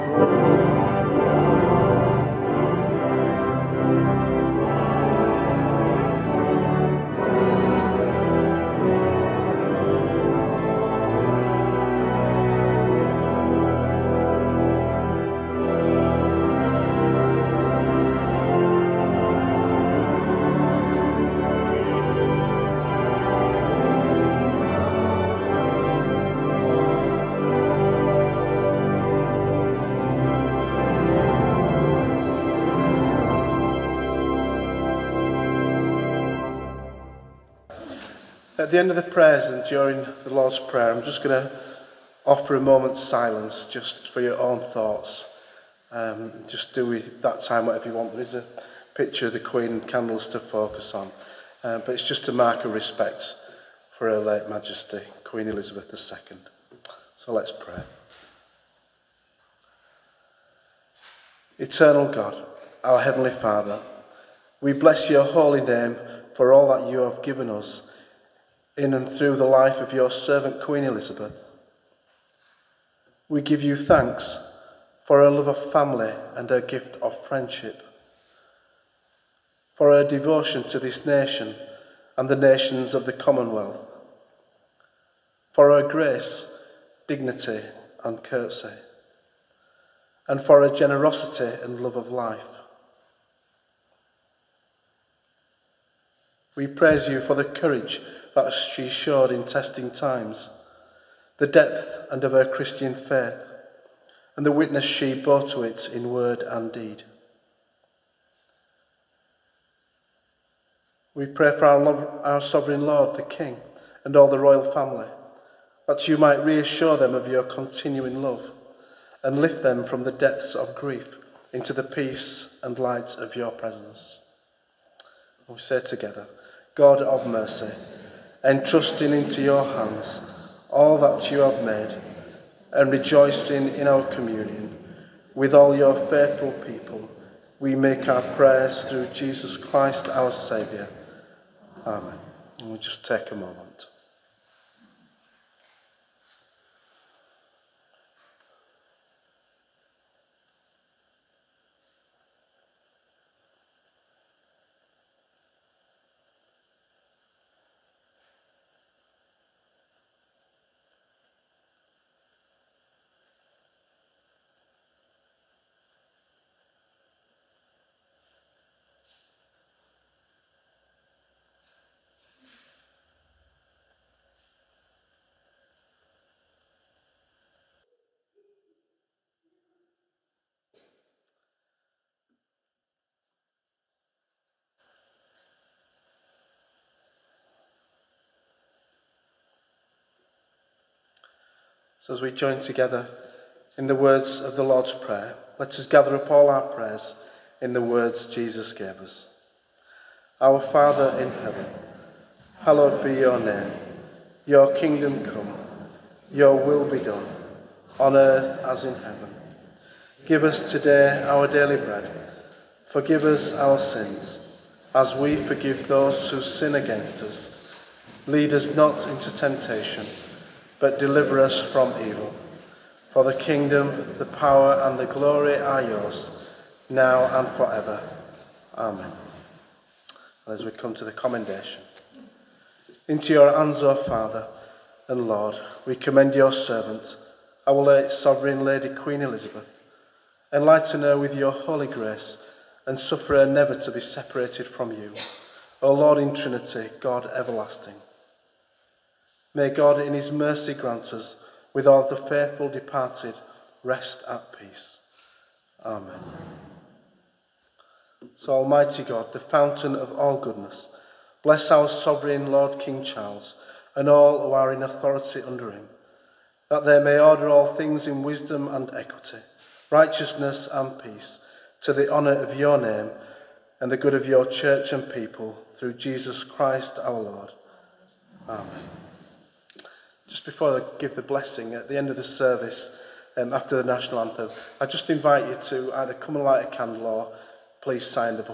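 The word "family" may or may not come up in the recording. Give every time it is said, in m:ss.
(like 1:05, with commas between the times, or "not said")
1:15, 1:54.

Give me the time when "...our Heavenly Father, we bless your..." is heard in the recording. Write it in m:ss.
1:02.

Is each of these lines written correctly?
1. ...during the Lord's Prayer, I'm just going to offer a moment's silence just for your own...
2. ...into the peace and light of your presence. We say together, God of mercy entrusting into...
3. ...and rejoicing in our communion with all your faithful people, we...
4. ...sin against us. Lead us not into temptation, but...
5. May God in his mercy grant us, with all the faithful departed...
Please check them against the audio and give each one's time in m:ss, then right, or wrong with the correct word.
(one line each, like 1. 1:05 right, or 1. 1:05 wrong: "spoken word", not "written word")
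1. 0:39 right
2. 2:01 right
3. 2:12 right
4. 3:36 right
5. 4:09 right.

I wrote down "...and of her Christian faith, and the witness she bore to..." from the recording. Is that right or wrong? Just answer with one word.
right.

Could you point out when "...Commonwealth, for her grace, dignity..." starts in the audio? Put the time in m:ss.
1:23.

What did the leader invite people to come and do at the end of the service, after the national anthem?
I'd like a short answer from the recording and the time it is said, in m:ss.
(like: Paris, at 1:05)
light a candle, at 4:46.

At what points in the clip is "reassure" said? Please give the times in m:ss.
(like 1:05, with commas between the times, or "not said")
1:56.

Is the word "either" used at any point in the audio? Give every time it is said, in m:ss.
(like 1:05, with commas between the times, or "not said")
4:45.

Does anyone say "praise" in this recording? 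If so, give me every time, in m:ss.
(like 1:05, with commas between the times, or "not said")
1:36.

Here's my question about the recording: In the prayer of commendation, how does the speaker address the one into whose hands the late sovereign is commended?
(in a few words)
O Father and Lord.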